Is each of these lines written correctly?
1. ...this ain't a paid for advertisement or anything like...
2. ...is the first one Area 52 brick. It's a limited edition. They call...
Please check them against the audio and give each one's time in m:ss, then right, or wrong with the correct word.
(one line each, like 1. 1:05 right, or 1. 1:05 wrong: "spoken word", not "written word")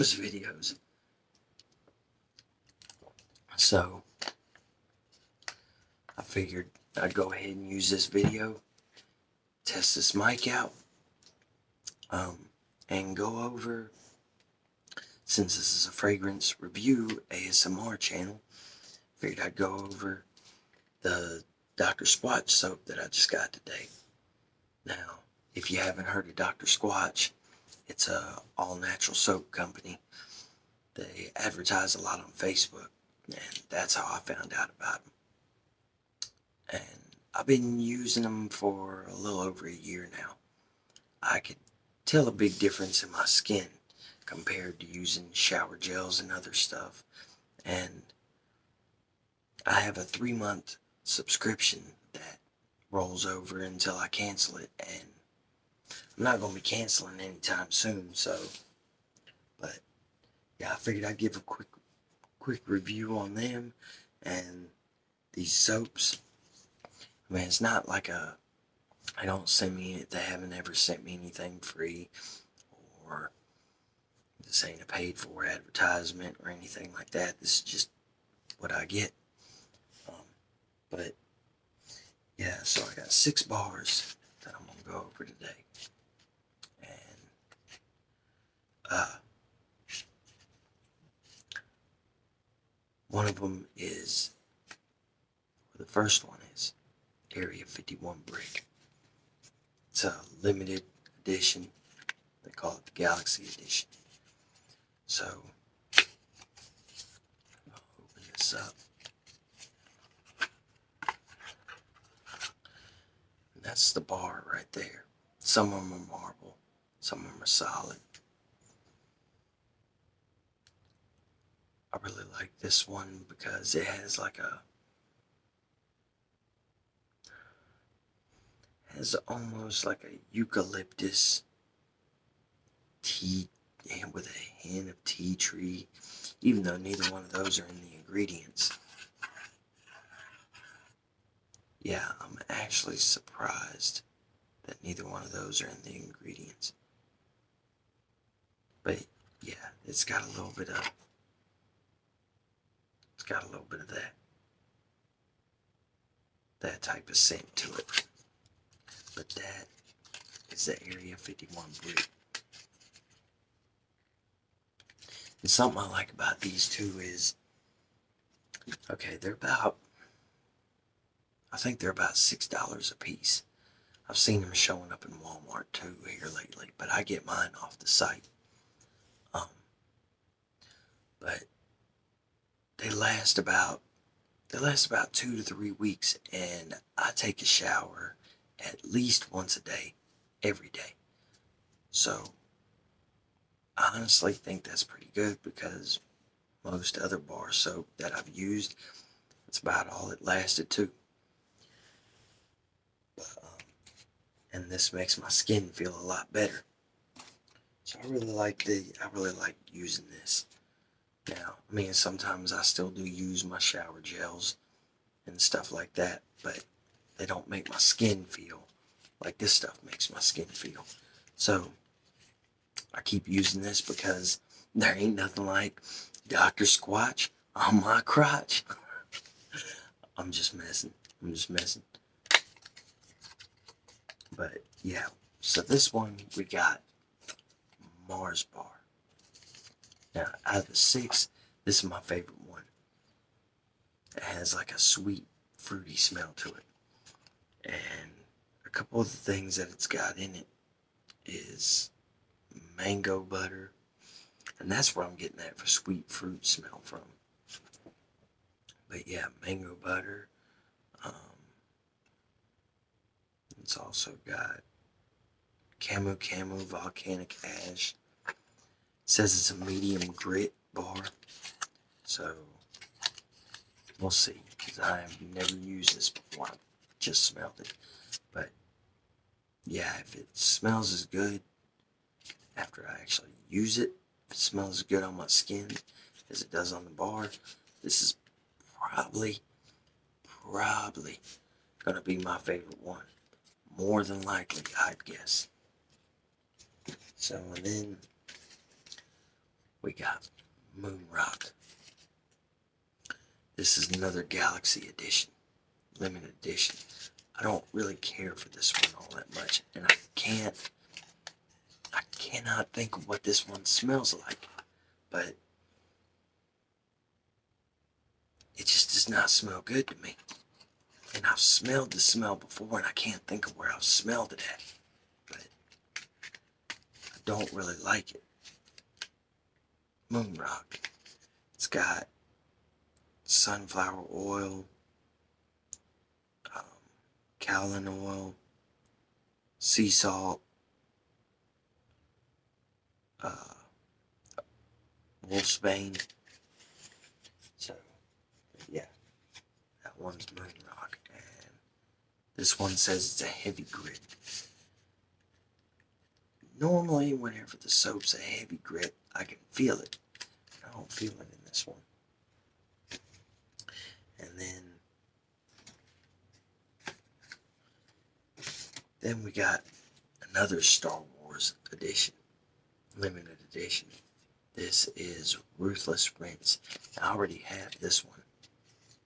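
1. 1:14 right
2. 1:33 wrong: "51", not "52".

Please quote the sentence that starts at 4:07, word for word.
And a couple of the things that it's got in it is mango butter.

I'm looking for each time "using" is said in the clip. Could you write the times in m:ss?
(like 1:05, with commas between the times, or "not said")
0:37, 0:44, 3:29, 3:43.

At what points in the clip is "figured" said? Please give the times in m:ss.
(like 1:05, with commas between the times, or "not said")
0:06, 0:19, 1:00.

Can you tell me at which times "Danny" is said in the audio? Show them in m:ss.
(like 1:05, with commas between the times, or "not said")
not said.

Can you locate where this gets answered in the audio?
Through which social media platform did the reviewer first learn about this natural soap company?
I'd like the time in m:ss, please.
0:32.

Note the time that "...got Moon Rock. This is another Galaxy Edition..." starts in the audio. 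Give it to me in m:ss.
4:59.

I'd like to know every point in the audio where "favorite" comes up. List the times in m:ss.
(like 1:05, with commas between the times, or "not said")
4:02, 4:52.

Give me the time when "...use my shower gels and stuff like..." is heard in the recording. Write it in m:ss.
3:33.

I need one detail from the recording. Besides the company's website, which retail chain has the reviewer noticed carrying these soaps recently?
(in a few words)
Walmart.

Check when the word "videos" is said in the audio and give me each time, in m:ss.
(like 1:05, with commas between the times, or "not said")
0:00, 0:08.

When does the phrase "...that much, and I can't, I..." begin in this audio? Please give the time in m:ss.
5:09.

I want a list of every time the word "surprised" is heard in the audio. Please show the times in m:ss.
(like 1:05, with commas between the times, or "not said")
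2:22.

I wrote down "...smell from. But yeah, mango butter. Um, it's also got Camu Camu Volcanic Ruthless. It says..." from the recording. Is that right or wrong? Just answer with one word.
wrong.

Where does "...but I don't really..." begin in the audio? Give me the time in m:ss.
5:25.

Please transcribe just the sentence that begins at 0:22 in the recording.
Squatch soap that I just got today.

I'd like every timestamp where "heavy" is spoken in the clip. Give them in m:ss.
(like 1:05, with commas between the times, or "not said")
5:53, 5:58.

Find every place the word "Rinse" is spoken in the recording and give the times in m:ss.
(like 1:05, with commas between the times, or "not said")
6:16.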